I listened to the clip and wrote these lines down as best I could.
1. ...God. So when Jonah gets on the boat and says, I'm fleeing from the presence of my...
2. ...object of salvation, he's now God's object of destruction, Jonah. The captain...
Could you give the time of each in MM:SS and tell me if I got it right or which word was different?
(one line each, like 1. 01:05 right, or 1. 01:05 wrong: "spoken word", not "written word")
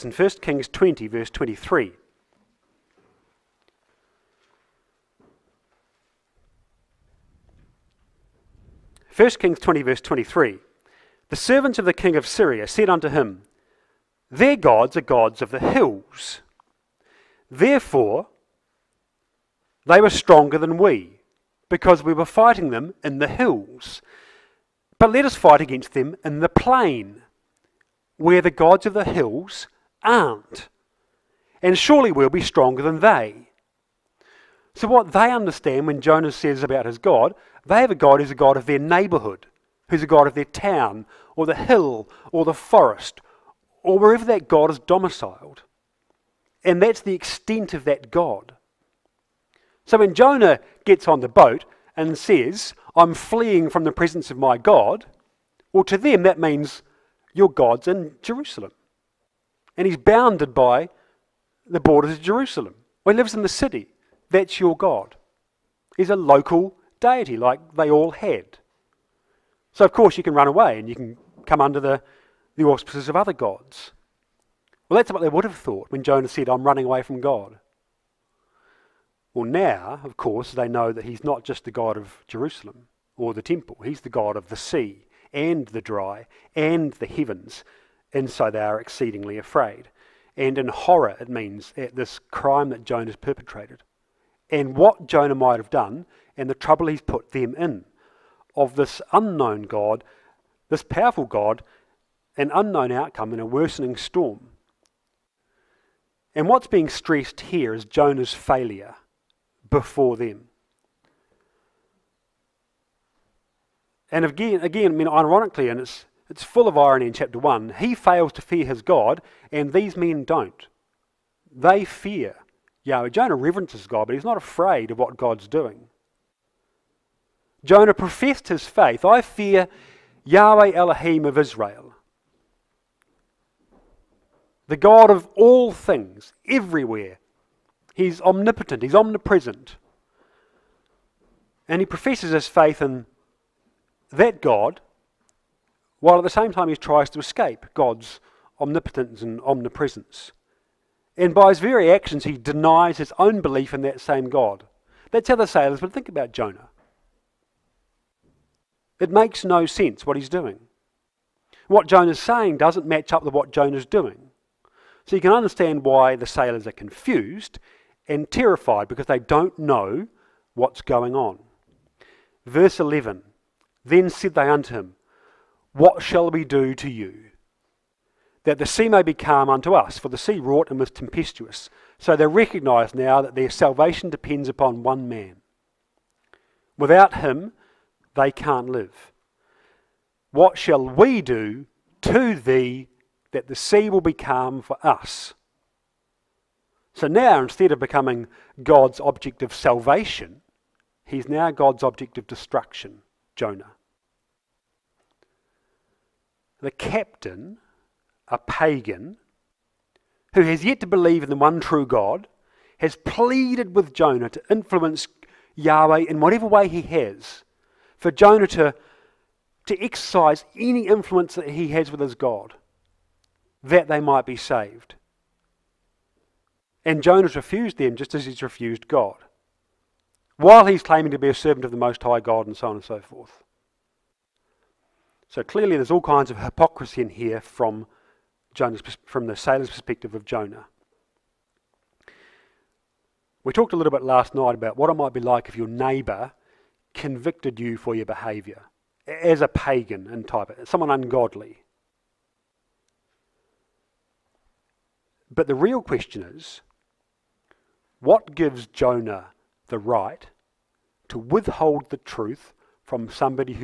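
1. 00:48 right
2. 03:18 right.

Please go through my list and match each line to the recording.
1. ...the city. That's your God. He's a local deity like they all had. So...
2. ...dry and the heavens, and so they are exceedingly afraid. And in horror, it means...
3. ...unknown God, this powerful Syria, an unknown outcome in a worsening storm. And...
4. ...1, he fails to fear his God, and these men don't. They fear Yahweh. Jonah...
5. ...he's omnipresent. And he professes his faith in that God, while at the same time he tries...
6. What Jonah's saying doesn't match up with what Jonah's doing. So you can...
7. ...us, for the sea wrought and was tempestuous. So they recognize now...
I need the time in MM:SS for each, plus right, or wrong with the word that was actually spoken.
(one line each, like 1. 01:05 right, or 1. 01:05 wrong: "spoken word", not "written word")
1. 01:03 right
2. 01:25 right
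3. 01:39 wrong: "God", not "Syria"
4. 01:57 right
5. 02:18 right
6. 02:41 right
7. 02:59 right.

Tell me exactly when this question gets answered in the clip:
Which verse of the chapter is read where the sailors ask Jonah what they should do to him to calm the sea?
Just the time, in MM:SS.
02:52.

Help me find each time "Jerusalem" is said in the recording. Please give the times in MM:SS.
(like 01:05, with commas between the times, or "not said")
00:58, 01:02, 01:22.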